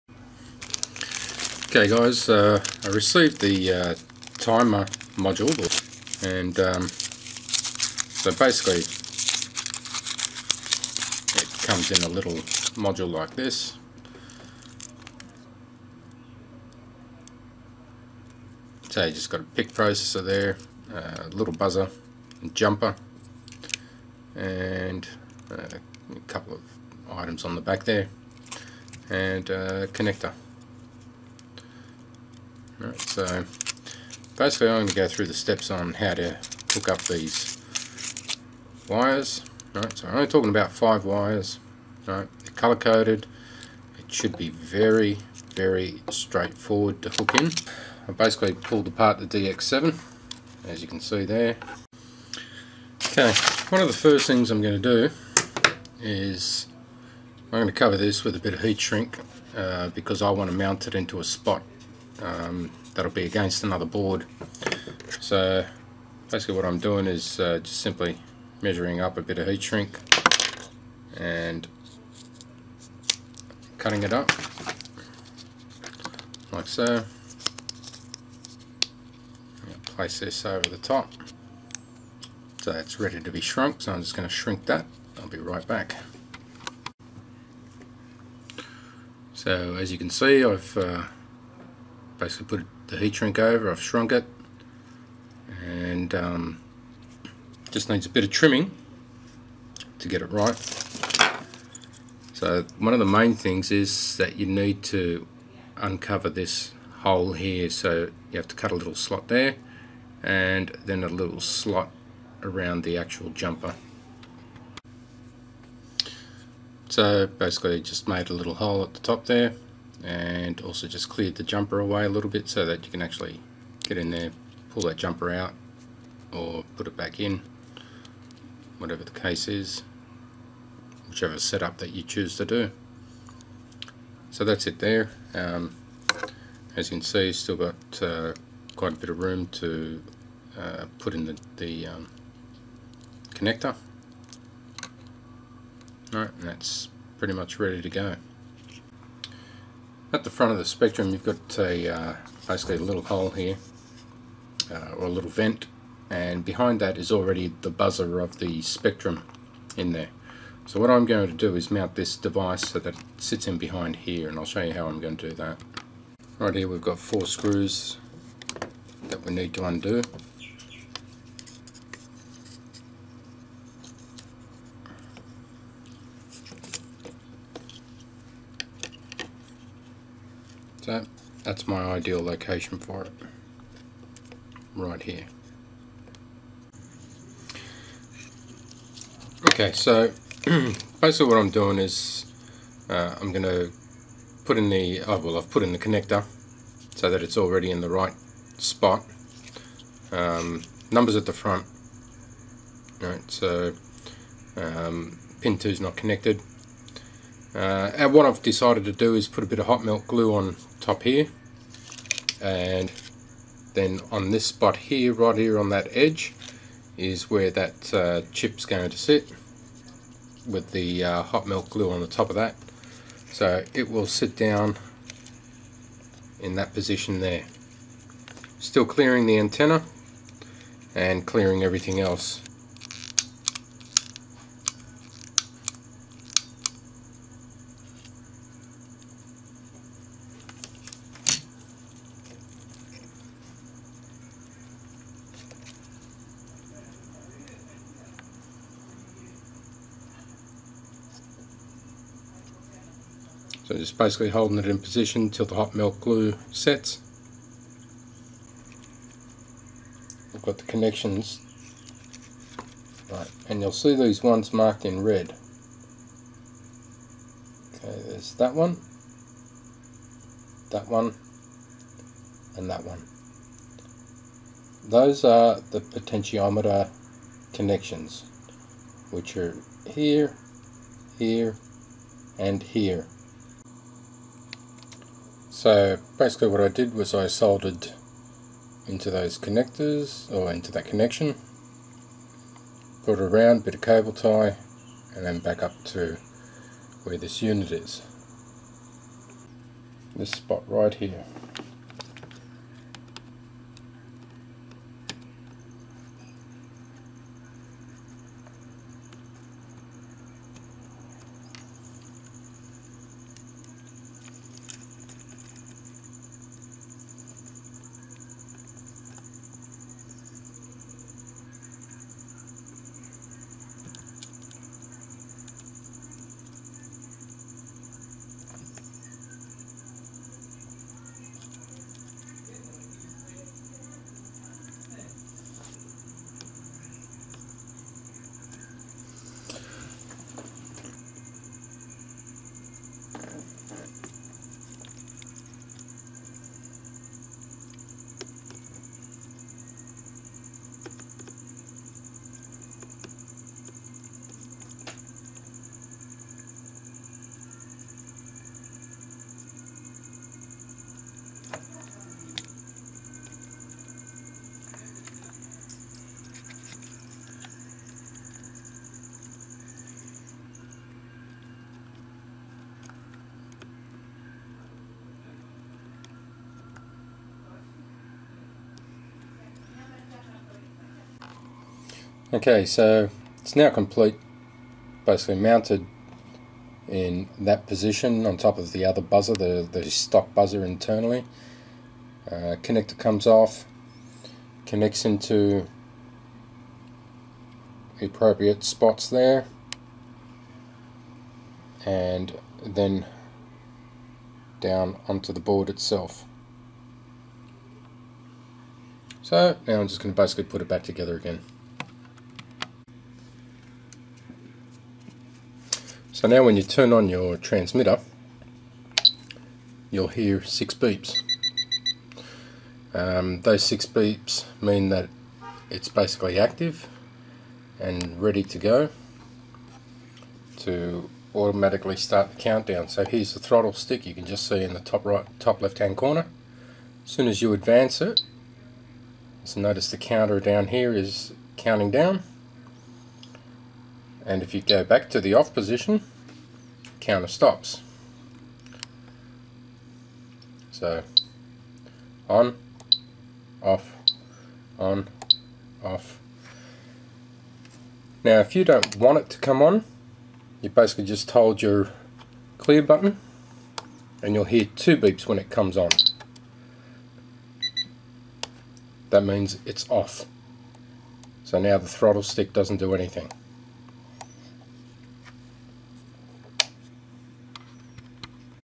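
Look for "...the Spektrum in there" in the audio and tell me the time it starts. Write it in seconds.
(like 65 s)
158 s.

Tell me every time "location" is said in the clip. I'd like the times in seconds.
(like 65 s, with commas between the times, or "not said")
182 s.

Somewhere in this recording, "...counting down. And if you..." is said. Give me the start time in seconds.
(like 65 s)
441 s.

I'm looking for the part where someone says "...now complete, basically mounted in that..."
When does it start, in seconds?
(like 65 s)
383 s.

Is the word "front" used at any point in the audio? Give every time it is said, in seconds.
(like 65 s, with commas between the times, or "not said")
150 s, 201 s.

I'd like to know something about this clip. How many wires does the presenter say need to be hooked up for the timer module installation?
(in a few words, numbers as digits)
5.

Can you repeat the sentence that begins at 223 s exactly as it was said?
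So it will sit down in that position there.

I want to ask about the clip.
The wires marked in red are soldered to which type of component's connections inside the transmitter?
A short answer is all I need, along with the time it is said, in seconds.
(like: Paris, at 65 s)
Potentiometer, at 275 s.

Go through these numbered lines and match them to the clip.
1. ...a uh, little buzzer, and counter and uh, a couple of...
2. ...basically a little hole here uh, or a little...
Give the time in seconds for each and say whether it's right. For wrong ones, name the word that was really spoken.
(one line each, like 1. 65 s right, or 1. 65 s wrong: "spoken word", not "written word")
1. 20 s wrong: "jumper", not "counter"
2. 152 s right.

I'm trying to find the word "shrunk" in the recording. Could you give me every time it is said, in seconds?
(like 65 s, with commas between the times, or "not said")
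83 s, 93 s.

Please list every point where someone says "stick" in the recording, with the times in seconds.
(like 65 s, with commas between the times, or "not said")
433 s, 472 s.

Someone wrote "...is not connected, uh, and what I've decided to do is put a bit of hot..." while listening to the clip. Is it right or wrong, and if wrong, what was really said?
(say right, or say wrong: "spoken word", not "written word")
right.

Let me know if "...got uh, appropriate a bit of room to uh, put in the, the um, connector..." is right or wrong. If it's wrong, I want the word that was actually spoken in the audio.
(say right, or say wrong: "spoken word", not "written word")
wrong: "quite", not "appropriate".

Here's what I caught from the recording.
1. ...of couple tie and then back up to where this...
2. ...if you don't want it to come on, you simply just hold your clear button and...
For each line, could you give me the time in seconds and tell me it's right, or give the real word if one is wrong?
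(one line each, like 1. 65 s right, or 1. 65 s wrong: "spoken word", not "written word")
1. 293 s wrong: "cable", not "couple"
2. 458 s wrong: "basically", not "simply".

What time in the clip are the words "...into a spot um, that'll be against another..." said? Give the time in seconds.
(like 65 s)
60 s.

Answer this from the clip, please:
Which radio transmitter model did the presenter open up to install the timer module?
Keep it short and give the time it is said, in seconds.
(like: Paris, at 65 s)
DX7, at 49 s.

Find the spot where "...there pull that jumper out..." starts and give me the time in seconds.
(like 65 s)
124 s.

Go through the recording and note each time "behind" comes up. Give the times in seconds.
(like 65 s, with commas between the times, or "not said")
156 s, 163 s.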